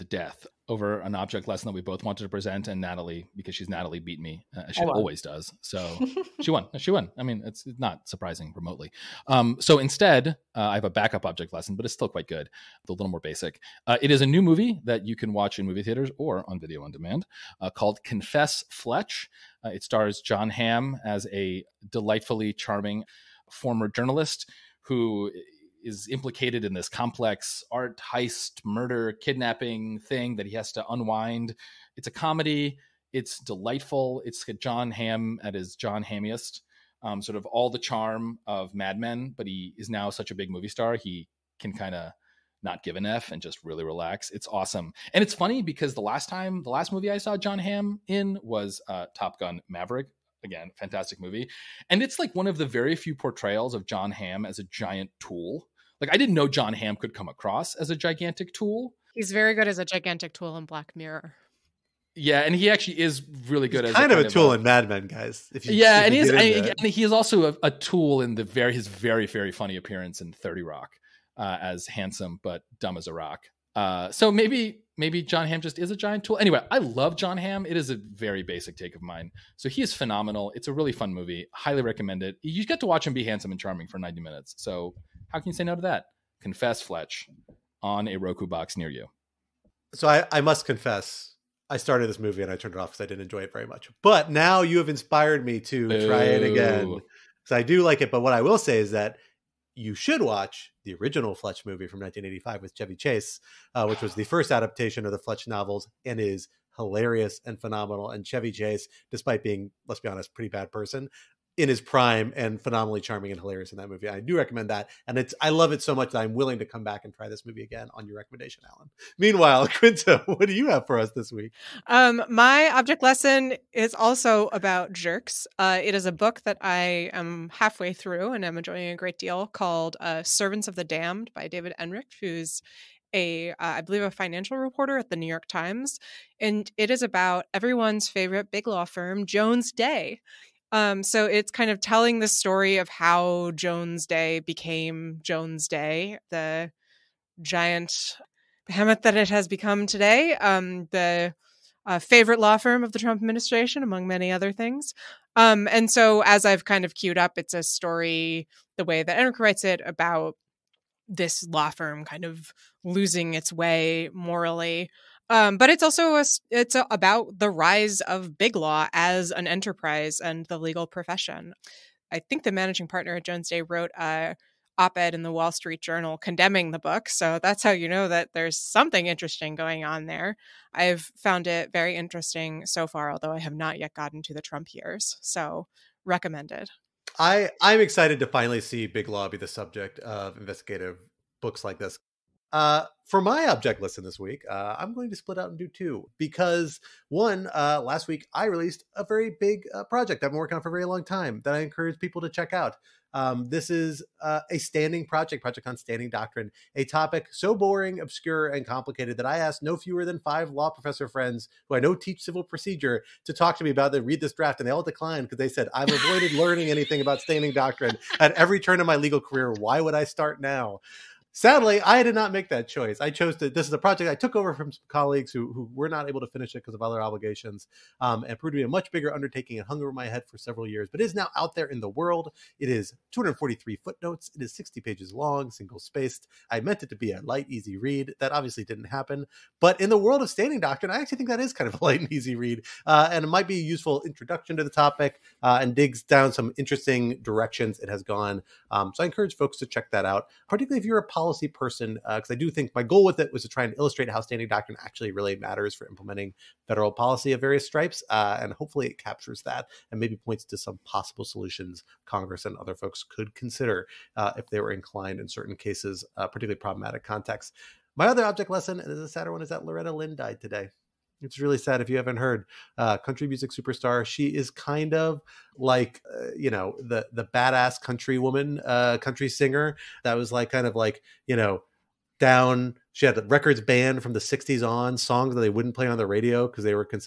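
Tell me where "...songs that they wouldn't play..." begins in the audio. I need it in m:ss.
4:44.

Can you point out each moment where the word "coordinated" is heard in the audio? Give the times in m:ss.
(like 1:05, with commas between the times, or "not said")
not said.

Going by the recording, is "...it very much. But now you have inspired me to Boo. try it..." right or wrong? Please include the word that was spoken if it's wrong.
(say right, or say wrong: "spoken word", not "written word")
right.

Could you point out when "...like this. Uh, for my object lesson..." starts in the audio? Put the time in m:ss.
3:11.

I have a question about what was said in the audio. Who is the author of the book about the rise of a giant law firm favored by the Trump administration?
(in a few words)
David Enrich.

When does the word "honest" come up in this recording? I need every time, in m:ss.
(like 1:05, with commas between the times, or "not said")
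1:50.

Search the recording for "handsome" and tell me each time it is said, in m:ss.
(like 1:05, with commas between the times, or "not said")
1:11, 1:23.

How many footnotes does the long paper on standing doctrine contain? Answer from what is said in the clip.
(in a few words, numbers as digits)
243.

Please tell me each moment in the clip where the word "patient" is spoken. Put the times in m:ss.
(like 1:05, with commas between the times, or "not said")
not said.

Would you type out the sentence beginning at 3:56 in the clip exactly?
I meant it to be a light, easy read.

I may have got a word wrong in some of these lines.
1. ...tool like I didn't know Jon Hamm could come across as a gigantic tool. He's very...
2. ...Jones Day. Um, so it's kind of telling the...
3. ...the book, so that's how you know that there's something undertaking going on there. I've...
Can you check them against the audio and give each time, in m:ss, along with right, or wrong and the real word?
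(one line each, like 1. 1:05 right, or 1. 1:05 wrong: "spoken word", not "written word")
1. 0:55 right
2. 2:19 right
3. 2:56 wrong: "interesting", not "undertaking".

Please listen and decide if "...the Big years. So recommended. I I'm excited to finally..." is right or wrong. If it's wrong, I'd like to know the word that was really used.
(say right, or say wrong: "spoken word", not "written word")
wrong: "Trump", not "Big".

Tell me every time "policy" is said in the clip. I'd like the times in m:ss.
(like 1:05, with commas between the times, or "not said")
4:11, 4:16.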